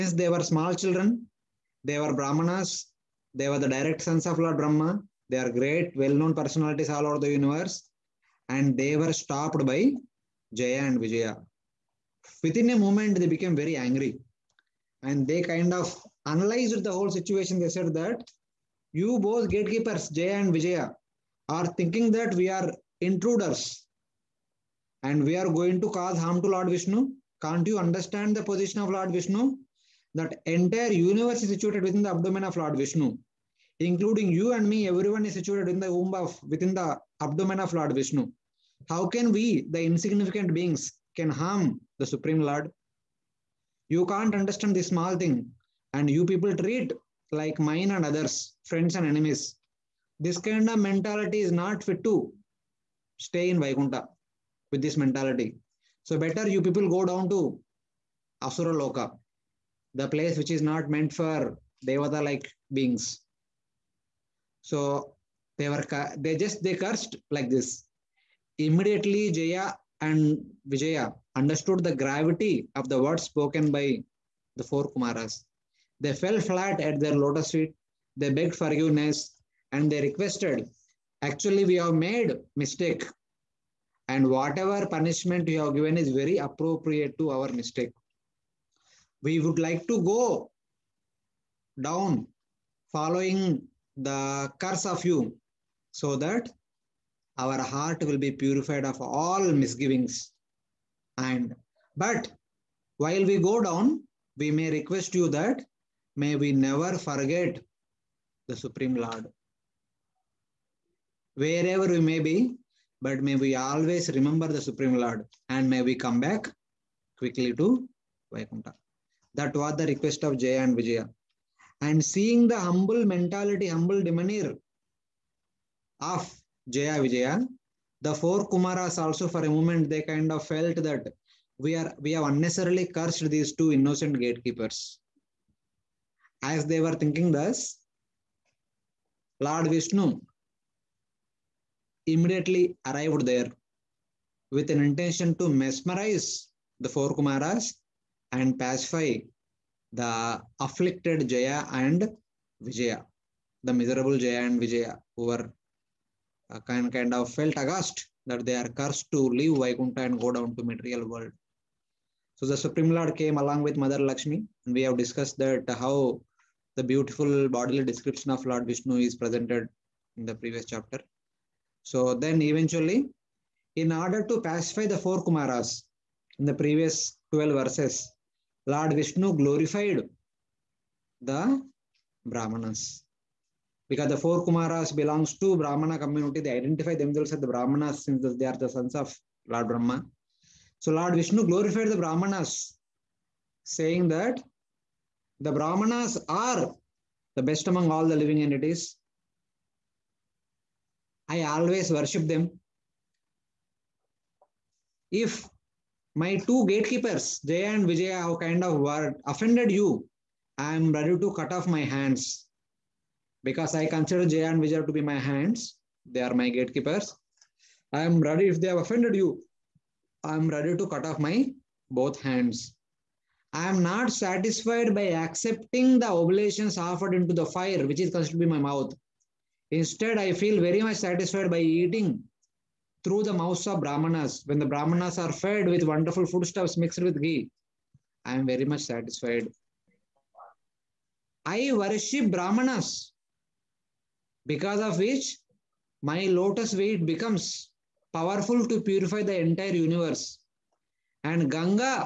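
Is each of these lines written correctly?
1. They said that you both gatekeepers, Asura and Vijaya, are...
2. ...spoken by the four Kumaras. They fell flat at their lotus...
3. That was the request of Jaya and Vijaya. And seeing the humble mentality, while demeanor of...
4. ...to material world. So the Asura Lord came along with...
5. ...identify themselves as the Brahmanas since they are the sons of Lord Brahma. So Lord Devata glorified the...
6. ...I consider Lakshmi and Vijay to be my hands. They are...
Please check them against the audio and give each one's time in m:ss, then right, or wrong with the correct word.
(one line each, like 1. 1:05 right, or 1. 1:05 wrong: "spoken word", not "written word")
1. 0:17 wrong: "Jaya", not "Asura"
2. 1:13 right
3. 1:59 wrong: "humble", not "while"
4. 2:40 wrong: "Supreme", not "Asura"
5. 3:06 wrong: "Vishnu", not "Devata"
6. 3:33 wrong: "Jay", not "Lakshmi".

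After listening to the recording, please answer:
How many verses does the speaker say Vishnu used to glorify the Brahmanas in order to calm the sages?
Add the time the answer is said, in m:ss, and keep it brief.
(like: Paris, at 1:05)
12, at 2:57.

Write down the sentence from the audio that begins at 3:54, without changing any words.
When the brahmanas are fed with wonderful foodstuffs mixed with ghee, I am very much satisfied.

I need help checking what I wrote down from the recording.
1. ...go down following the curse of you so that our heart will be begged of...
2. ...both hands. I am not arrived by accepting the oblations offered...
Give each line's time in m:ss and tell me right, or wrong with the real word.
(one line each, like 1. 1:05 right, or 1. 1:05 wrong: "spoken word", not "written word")
1. 1:30 wrong: "purified", not "begged"
2. 3:41 wrong: "satisfied", not "arrived".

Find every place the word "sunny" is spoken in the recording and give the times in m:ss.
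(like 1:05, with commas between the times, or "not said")
not said.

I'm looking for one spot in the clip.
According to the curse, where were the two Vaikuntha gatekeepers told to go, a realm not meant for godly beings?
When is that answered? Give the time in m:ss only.
0:58.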